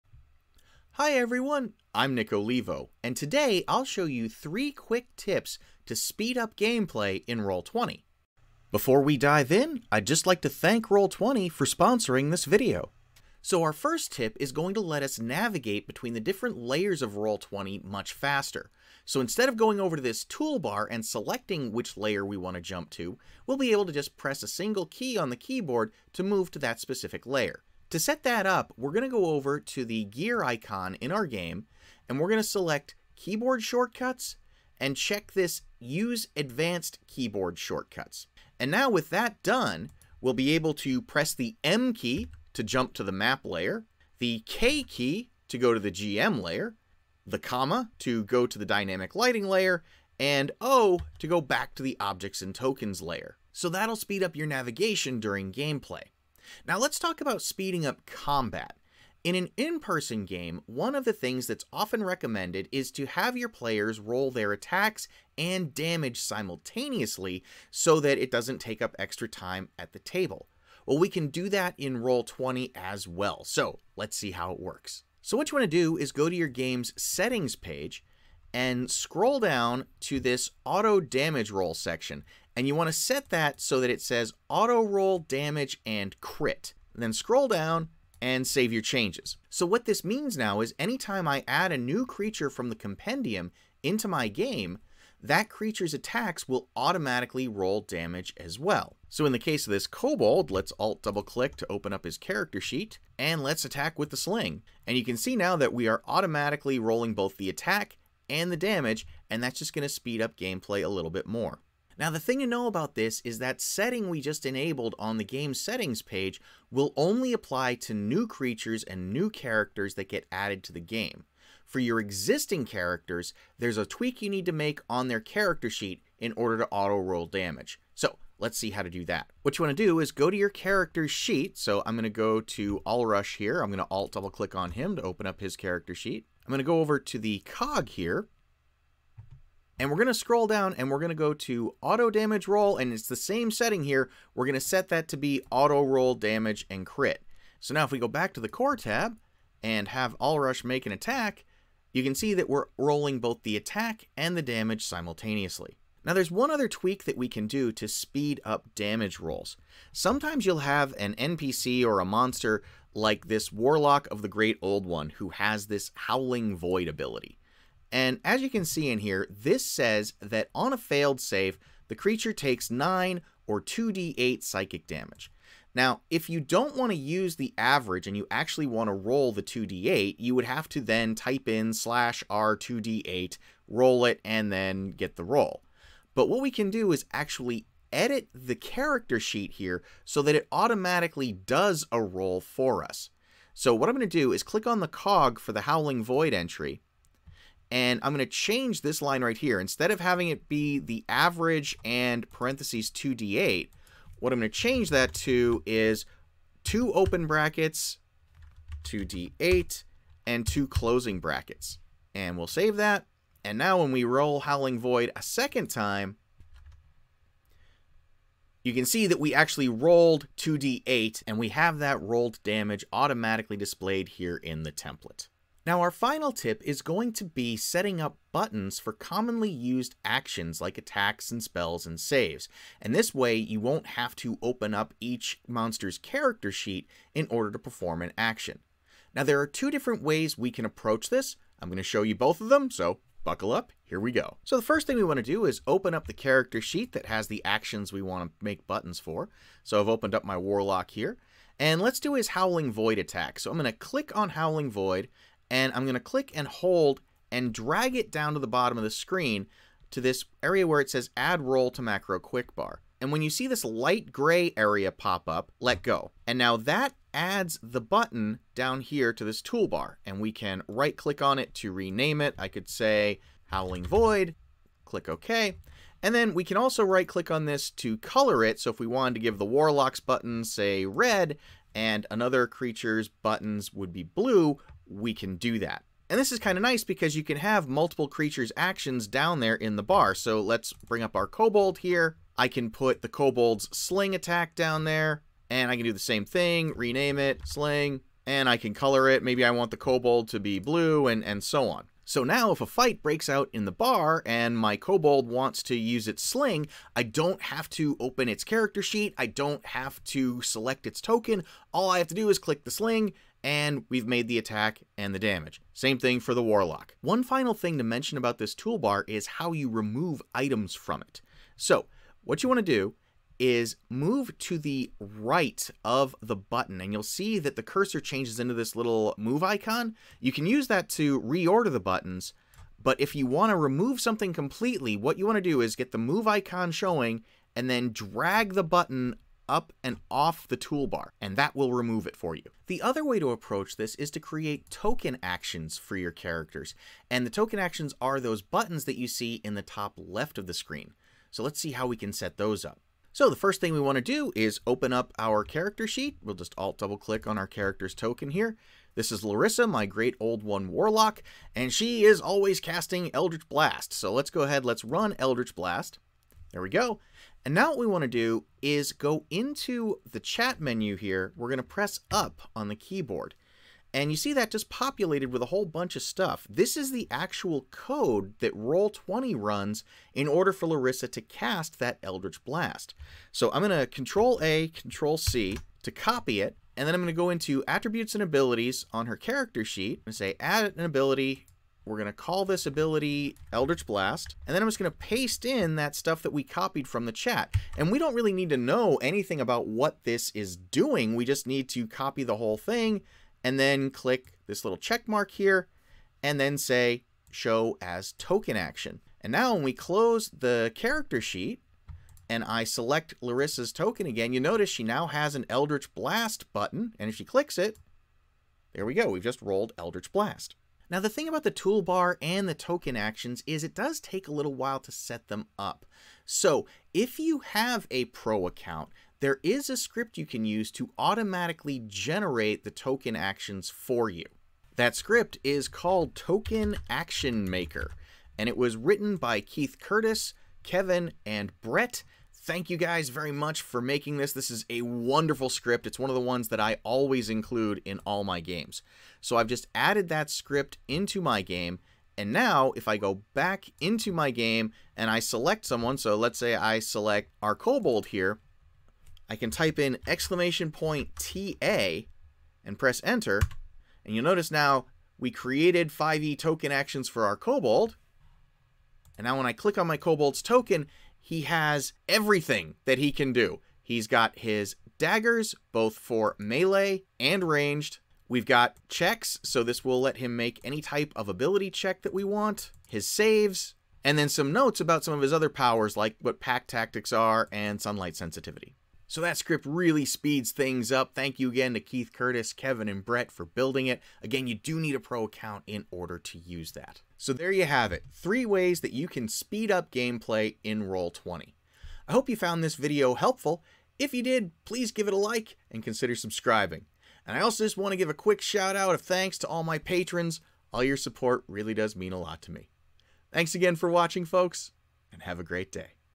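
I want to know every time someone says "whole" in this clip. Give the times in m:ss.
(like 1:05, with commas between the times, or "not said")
6:15, 6:42.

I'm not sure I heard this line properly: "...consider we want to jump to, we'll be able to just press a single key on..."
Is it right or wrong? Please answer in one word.
wrong.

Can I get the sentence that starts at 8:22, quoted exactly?
I hope you found this video helpful.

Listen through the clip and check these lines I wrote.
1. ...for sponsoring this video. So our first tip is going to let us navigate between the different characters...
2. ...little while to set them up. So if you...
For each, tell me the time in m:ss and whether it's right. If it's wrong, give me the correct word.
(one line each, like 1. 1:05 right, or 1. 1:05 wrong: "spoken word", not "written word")
1. 0:11 wrong: "layers", not "characters"
2. 7:04 right.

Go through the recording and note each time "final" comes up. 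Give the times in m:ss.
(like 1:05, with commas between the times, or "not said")
3:45, 5:17.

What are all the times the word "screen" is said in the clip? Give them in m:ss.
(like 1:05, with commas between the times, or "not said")
4:18, 5:50.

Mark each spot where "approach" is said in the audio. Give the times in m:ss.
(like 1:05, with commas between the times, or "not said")
4:00, 5:43.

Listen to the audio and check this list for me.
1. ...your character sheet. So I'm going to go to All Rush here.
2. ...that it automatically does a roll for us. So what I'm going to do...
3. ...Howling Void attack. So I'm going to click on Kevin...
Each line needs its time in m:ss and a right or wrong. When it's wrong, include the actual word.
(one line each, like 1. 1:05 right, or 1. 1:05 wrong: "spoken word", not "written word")
1. 2:10 right
2. 3:10 right
3. 4:12 wrong: "Howling", not "Kevin".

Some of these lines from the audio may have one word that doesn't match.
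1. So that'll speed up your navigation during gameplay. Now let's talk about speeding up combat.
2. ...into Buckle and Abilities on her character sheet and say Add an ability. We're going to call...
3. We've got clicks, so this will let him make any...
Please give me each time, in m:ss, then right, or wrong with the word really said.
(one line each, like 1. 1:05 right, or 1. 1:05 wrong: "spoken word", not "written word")
1. 0:53 right
2. 6:27 wrong: "Attributes", not "Buckle"
3. 7:58 wrong: "checks", not "clicks".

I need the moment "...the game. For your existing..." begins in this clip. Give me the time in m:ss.
2:00.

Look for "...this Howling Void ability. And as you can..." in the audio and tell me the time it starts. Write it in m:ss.
2:45.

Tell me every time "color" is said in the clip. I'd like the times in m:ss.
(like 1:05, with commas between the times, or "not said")
4:37, 4:58.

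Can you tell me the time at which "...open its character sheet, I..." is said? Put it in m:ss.
5:07.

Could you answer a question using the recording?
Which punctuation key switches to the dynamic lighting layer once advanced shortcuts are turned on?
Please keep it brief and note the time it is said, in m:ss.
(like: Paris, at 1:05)
Comma, at 0:47.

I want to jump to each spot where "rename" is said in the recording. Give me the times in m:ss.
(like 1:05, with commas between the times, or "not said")
4:31, 4:56.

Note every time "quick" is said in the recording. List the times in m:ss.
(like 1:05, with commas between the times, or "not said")
0:04, 4:22, 8:28.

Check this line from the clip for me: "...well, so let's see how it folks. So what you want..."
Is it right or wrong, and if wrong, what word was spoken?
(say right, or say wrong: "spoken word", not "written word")
wrong: "works", not "folks".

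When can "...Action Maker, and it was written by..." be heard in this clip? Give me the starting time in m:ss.
7:16.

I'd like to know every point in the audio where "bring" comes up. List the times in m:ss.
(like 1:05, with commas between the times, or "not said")
4:50.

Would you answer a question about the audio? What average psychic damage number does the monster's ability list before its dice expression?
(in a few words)
9.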